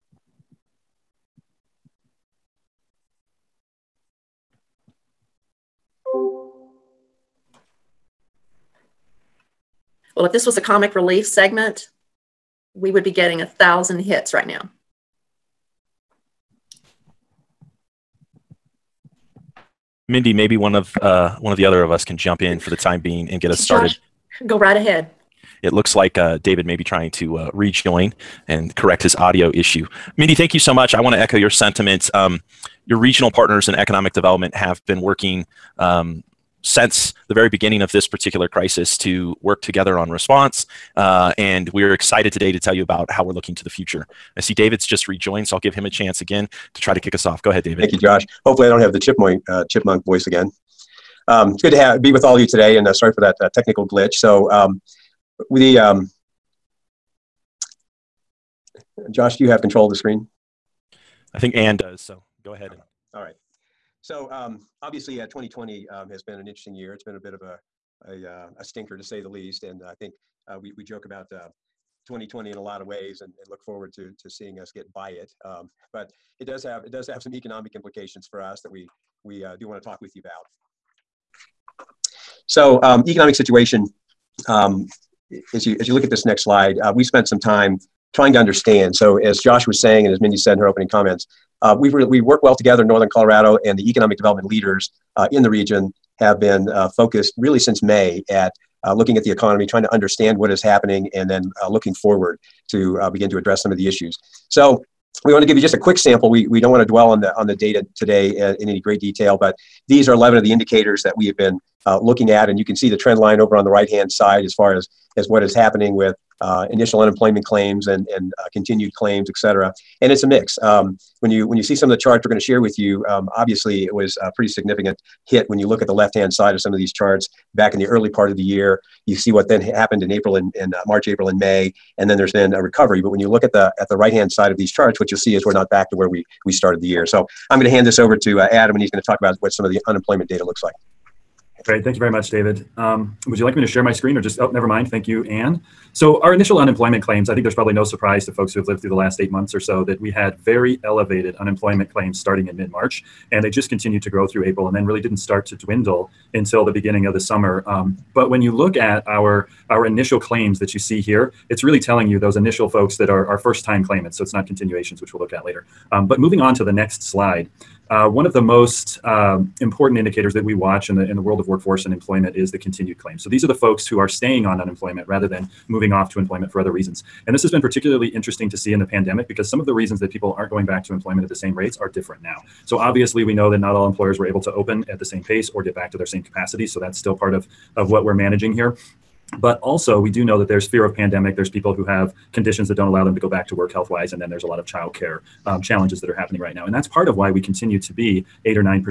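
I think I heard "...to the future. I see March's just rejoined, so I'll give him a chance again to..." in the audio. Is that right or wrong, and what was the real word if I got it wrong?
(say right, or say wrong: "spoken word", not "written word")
wrong: "David", not "March".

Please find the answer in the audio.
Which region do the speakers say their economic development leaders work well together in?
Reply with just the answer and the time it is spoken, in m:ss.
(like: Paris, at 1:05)
Northern Colorado, at 1:32.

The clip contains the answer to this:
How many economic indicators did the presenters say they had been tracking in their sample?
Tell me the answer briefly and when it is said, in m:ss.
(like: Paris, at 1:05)
11, at 1:50.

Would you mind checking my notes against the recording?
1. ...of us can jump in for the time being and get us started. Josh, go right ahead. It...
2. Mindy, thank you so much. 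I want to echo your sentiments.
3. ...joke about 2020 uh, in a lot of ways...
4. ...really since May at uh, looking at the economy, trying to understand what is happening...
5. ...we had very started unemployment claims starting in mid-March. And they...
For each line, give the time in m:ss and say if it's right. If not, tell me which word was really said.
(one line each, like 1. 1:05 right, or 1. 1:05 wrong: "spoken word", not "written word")
1. 0:21 right
2. 0:30 right
3. 1:10 right
4. 1:37 right
5. 2:29 wrong: "elevated", not "started".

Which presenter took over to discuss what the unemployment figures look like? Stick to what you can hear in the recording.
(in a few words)
Adam.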